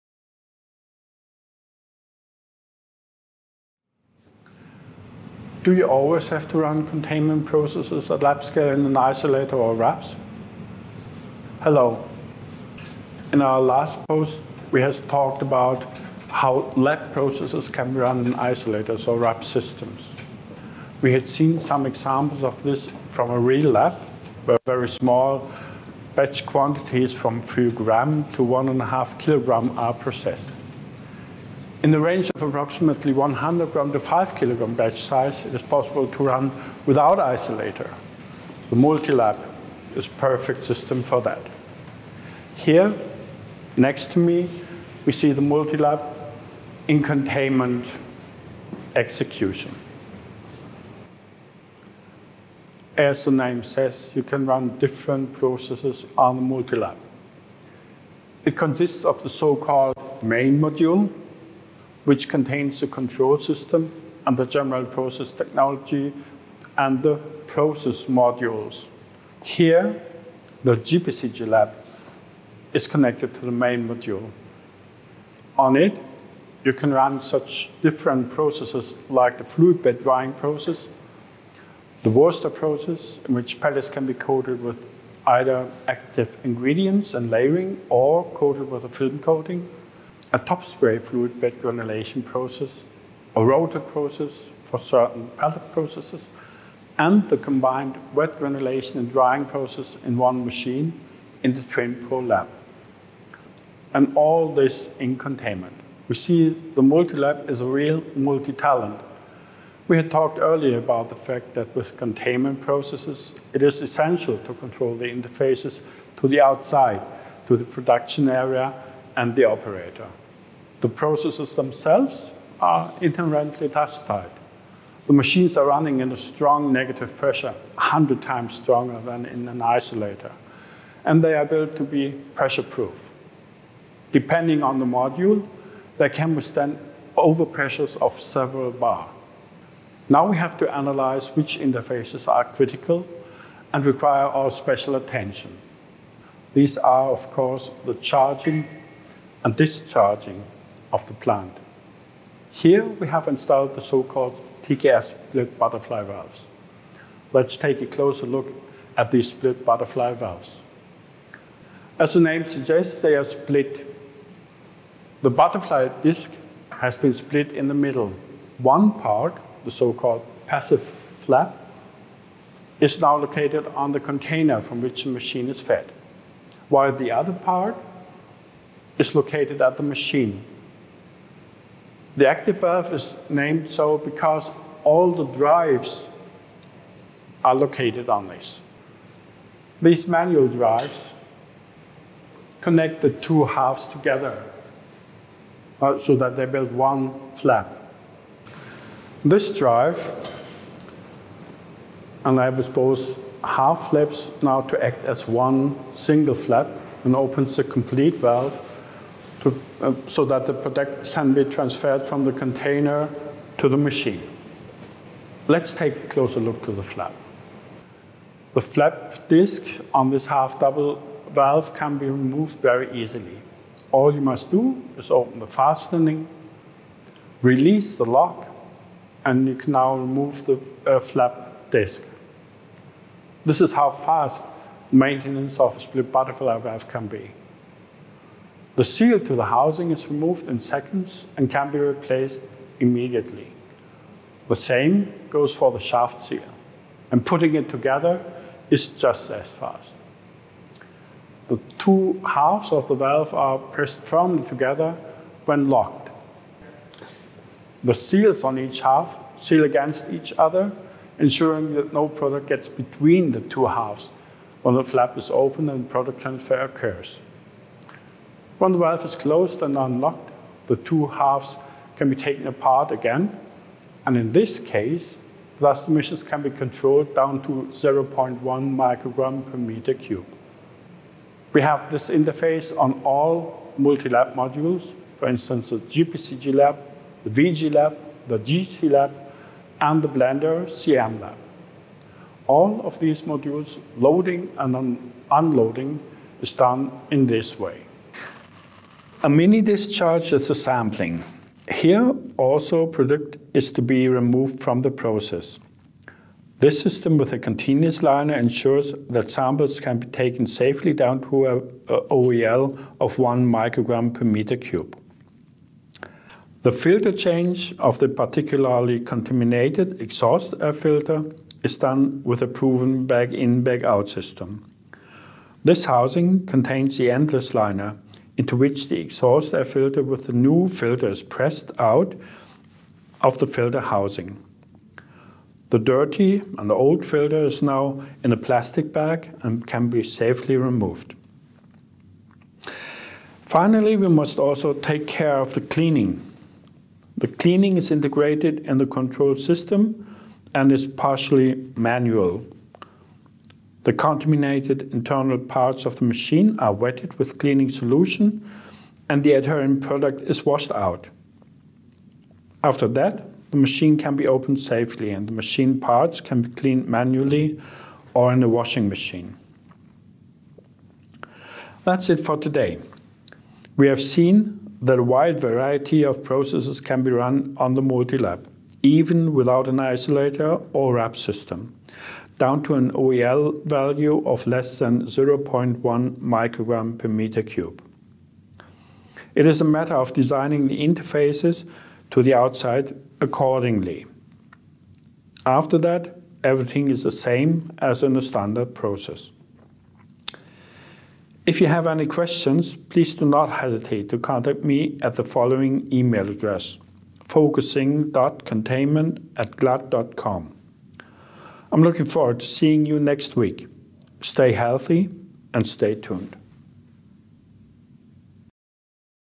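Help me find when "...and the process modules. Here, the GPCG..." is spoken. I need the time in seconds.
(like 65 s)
66 s.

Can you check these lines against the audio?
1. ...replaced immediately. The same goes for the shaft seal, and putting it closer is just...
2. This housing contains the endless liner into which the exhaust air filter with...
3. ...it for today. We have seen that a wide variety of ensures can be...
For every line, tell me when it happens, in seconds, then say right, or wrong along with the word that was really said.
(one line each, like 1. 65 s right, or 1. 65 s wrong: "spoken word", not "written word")
1. 241 s wrong: "together", not "closer"
2. 325 s right
3. 372 s wrong: "processes", not "ensures".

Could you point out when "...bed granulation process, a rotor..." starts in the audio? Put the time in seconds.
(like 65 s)
91 s.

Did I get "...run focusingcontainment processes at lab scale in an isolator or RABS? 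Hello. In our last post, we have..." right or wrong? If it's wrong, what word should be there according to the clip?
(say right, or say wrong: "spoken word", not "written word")
wrong: "containment", not "focusingcontainment".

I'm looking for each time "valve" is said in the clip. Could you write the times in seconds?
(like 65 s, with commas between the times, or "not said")
156 s, 160 s, 182 s, 208 s, 221 s, 236 s, 252 s, 268 s.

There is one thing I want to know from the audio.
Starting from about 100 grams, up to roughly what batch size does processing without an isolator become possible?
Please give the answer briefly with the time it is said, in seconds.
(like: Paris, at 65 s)
5 kilograms, at 33 s.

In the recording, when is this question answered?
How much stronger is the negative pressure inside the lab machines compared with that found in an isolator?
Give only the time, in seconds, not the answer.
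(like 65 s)
127 s.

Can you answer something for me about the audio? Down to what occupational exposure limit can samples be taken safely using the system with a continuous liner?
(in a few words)
1 microgram per cubic meter.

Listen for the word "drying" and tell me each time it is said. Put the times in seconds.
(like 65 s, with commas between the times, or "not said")
80 s, 99 s.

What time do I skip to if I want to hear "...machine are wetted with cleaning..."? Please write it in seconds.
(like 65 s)
356 s.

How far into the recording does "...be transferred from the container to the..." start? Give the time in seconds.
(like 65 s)
211 s.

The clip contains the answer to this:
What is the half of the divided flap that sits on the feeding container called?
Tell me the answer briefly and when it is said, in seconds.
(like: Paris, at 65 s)
passive flap, at 170 s.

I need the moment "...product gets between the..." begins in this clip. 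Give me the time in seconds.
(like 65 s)
262 s.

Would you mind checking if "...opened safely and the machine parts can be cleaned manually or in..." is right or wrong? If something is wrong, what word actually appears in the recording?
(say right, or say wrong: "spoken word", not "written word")
right.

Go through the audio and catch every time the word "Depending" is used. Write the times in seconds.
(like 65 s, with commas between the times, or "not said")
134 s.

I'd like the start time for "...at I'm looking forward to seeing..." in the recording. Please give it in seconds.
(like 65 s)
409 s.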